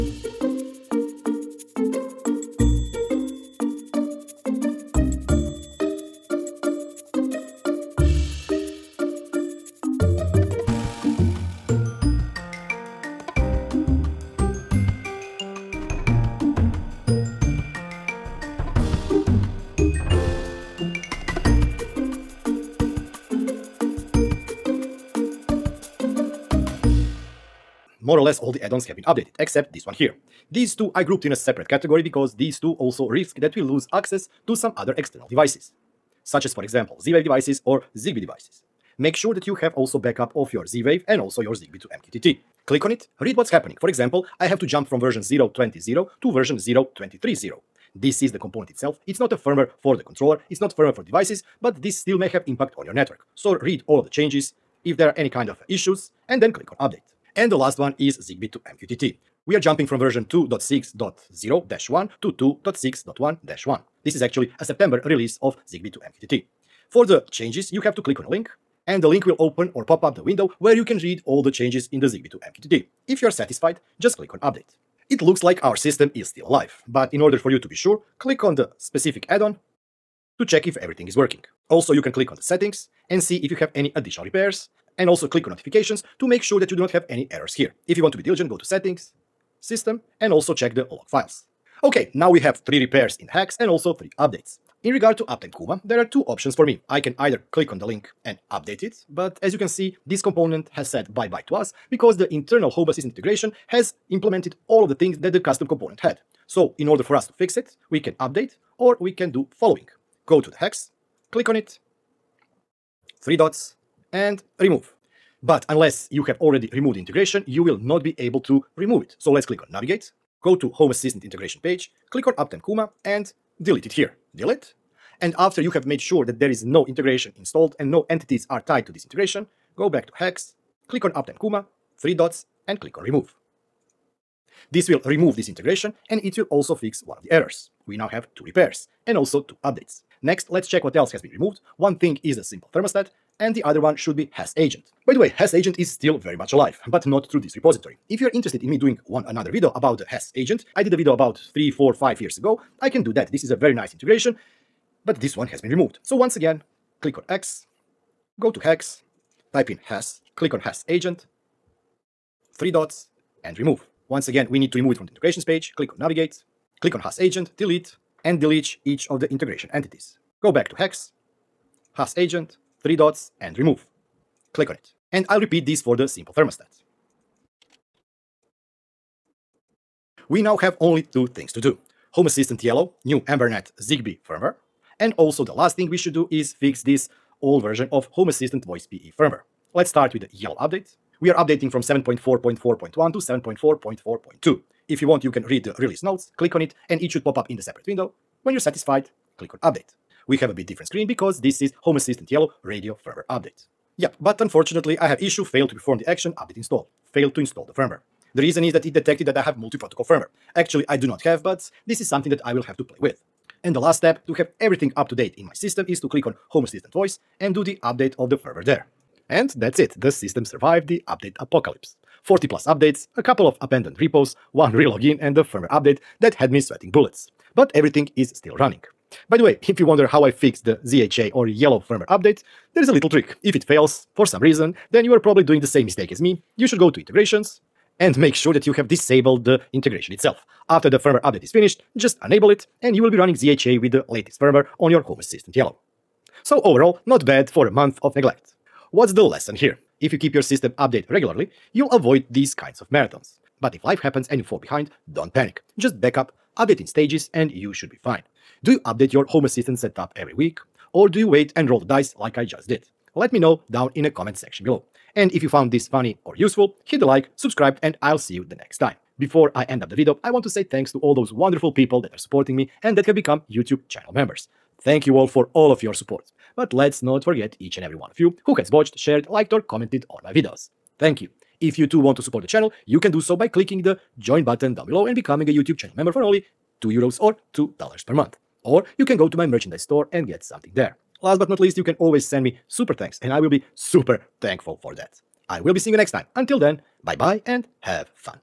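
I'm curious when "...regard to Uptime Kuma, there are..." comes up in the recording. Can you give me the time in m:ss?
1:34.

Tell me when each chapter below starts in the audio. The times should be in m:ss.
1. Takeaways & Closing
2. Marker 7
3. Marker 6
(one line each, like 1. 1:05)
1. 3:38
2. 1:31
3. 0:27.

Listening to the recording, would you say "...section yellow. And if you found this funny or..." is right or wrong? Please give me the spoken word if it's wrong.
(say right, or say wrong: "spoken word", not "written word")
wrong: "below", not "yellow".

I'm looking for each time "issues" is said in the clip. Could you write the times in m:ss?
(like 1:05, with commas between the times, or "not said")
0:55, 3:25.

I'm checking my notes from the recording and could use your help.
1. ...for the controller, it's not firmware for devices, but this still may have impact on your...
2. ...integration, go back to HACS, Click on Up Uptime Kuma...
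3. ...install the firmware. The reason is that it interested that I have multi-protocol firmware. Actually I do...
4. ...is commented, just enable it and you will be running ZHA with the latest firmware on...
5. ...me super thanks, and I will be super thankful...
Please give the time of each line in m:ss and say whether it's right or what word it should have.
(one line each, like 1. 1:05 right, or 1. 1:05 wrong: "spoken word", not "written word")
1. 0:49 right
2. 2:09 right
3. 3:27 wrong: "detected", not "interested"
4. 4:01 wrong: "finished", not "commented"
5. 4:52 right.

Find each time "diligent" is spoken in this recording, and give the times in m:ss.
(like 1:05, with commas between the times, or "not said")
1:28.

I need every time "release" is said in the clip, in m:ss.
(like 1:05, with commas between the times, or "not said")
1:05, 3:15.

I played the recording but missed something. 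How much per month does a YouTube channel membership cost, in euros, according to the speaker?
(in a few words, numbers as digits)
2 euros.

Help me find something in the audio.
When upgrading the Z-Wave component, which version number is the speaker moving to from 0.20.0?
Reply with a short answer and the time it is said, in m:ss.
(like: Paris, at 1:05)
0.23.0, at 0:46.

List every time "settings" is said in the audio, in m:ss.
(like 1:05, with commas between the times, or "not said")
1:22, 1:28.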